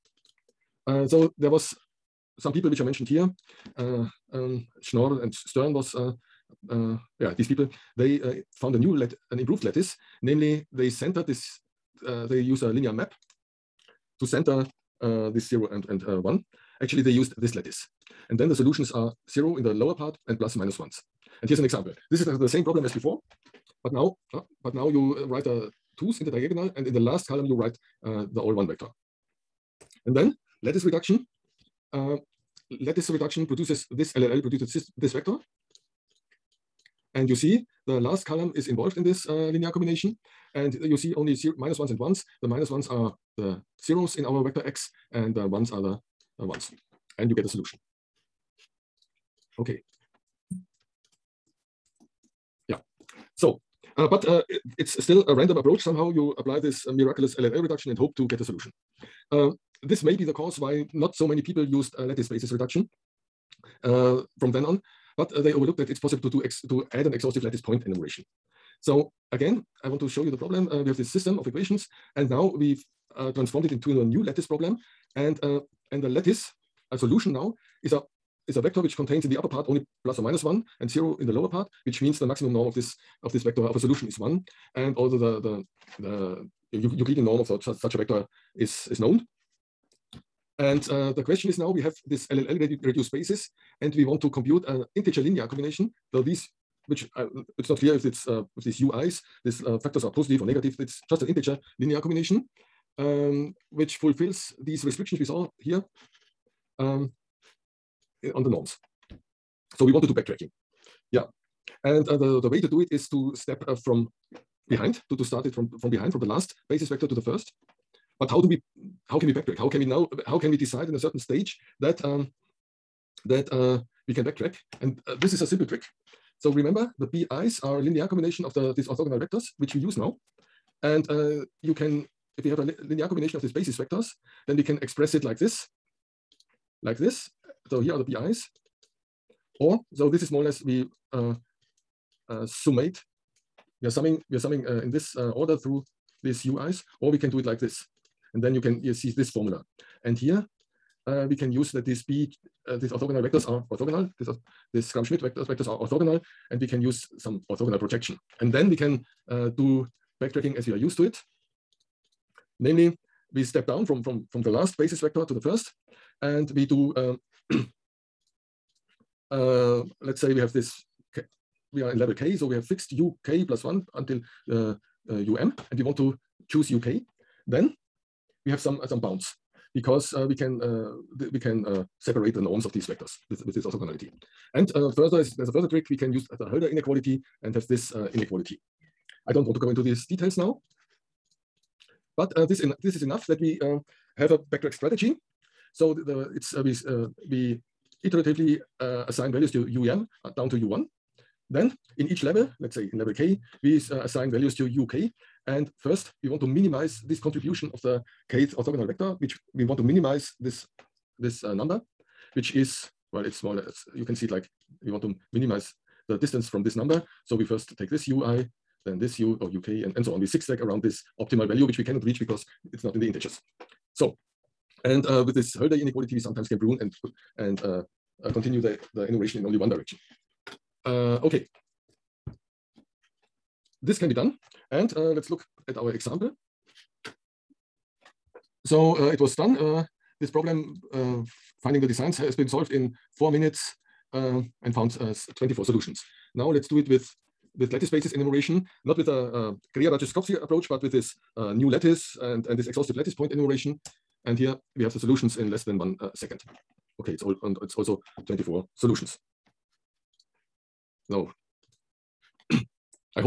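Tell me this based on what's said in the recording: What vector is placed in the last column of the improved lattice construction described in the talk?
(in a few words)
the all one vector.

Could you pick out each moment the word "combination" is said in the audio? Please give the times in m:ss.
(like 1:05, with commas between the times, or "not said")
0:39, 1:35, 1:42, 2:08, 2:13.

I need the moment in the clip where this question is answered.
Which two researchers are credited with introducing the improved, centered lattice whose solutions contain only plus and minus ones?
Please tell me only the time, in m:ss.
0:04.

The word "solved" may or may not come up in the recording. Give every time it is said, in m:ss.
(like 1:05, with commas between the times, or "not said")
4:02.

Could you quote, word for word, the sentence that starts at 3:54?
And uh, let's look at our example.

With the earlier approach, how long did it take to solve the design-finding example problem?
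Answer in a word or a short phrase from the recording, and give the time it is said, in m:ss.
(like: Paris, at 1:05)
4 minutes, at 4:03.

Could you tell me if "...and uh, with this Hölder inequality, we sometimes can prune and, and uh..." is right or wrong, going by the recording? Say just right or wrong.
right.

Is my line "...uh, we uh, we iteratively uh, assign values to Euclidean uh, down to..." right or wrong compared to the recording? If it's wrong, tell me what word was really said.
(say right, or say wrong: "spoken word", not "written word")
wrong: "UEM", not "Euclidean".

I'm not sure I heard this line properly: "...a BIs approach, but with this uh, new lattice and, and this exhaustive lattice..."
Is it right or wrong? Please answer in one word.
wrong.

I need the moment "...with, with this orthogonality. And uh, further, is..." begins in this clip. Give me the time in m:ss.
3:03.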